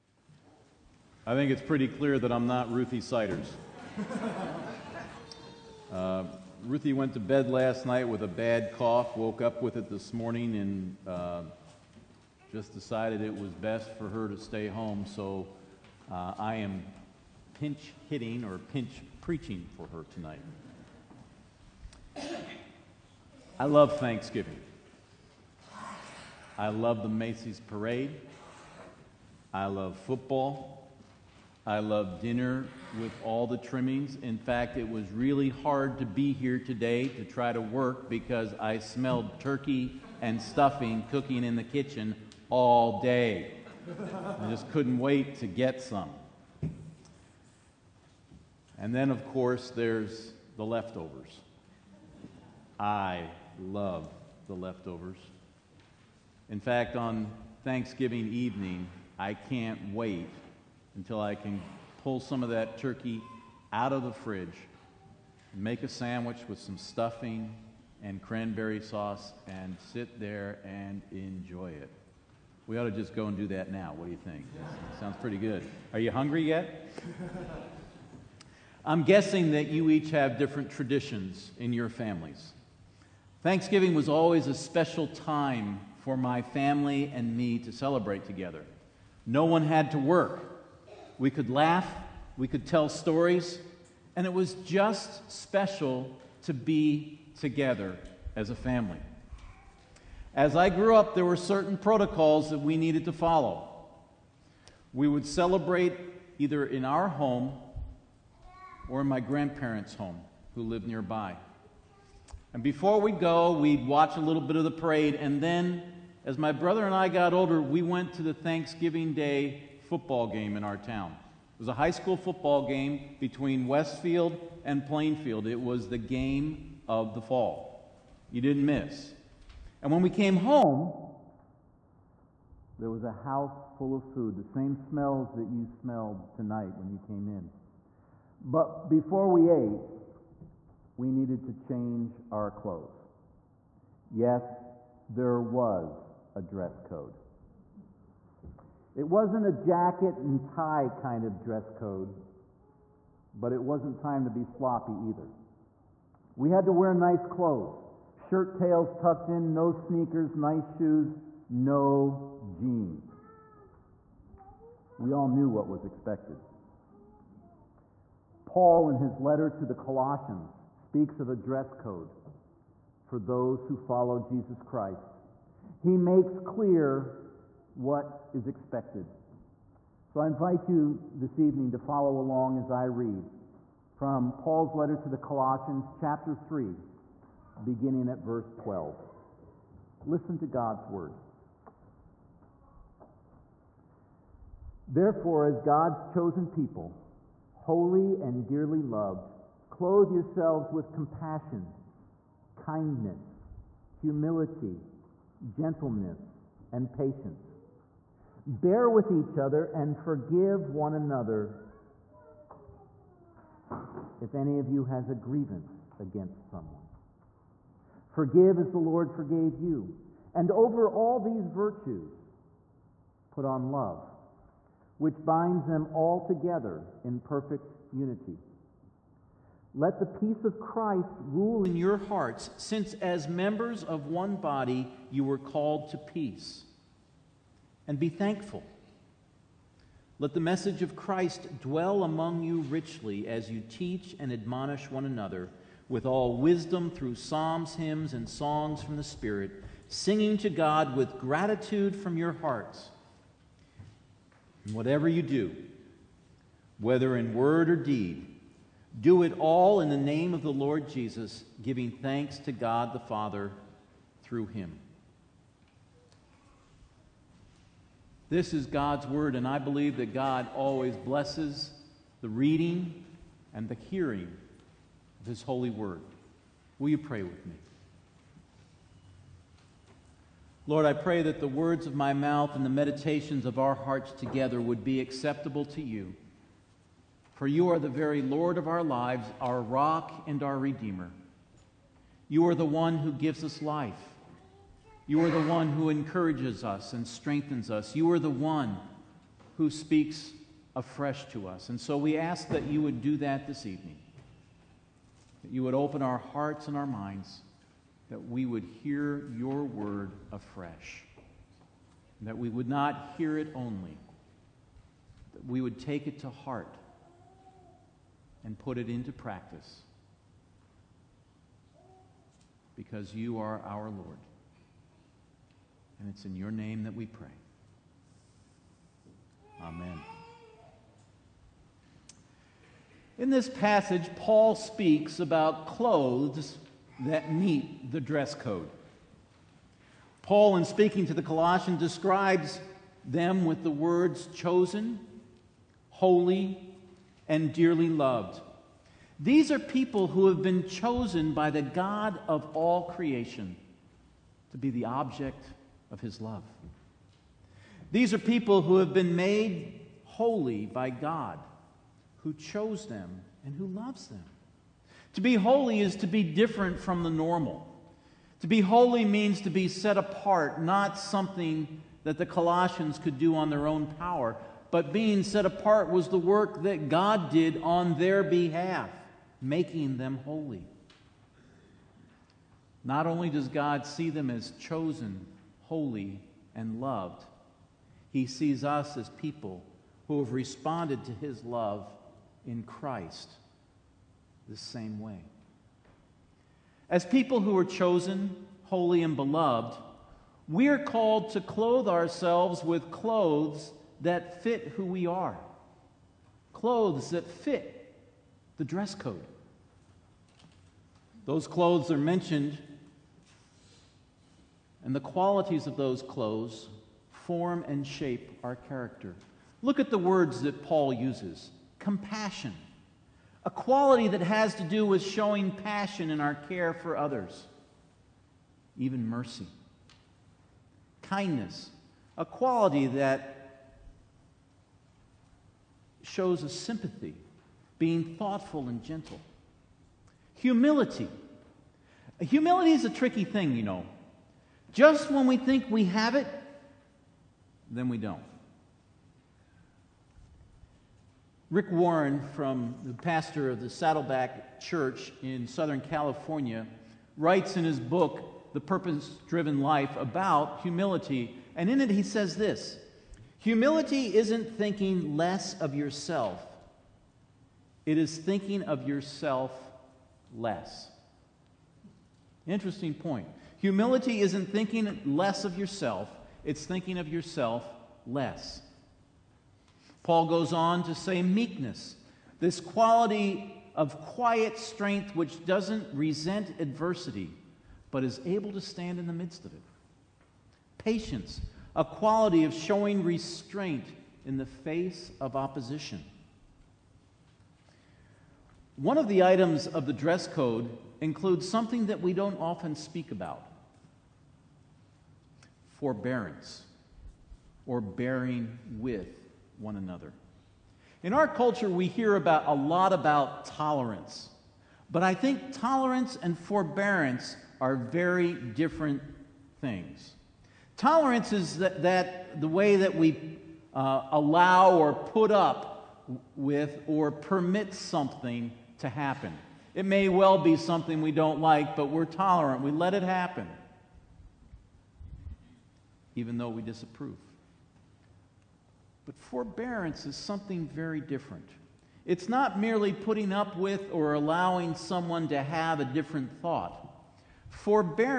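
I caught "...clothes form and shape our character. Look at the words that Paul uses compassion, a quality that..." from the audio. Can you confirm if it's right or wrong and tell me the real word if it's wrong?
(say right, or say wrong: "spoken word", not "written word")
right.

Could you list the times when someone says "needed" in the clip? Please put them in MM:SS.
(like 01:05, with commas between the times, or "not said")
01:42, 02:21.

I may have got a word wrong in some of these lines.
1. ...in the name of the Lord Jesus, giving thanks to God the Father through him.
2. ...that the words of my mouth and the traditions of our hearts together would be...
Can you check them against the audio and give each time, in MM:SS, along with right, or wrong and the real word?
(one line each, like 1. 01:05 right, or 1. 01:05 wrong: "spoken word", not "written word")
1. 04:19 right
2. 04:41 wrong: "meditations", not "traditions".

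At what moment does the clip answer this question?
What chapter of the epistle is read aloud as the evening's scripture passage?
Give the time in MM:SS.
03:05.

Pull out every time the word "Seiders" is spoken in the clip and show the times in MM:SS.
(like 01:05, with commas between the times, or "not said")
00:03.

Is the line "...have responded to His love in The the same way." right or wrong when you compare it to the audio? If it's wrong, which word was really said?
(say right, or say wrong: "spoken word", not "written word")
wrong: "Christ", not "The".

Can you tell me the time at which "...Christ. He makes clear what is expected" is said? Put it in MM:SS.
02:54.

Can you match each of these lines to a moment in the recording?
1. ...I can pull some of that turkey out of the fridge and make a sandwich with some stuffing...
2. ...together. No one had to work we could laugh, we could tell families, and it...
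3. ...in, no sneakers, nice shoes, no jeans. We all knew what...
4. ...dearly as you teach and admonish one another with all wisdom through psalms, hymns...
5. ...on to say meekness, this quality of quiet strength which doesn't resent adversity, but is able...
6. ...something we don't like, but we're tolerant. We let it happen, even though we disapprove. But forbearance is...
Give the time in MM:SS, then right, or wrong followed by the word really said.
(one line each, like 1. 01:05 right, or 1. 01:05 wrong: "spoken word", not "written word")
1. 01:01 right
2. 01:28 wrong: "stories", not "families"
3. 02:39 right
4. 04:02 wrong: "richly", not "dearly"
5. 08:00 right
6. 08:50 right.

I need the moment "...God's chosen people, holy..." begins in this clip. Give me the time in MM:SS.
03:15.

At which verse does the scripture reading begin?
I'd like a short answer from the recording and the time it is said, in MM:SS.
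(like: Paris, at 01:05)
12, at 03:08.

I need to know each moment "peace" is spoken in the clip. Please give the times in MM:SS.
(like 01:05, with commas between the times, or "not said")
03:50, 03:55.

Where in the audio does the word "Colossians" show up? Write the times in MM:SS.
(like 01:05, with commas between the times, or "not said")
02:49, 03:05, 05:41, 06:12.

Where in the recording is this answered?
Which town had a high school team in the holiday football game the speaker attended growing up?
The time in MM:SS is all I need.
02:03.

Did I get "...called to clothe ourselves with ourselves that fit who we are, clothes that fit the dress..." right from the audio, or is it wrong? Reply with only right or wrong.
wrong.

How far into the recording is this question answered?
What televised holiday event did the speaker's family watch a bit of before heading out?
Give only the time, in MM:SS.
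00:27.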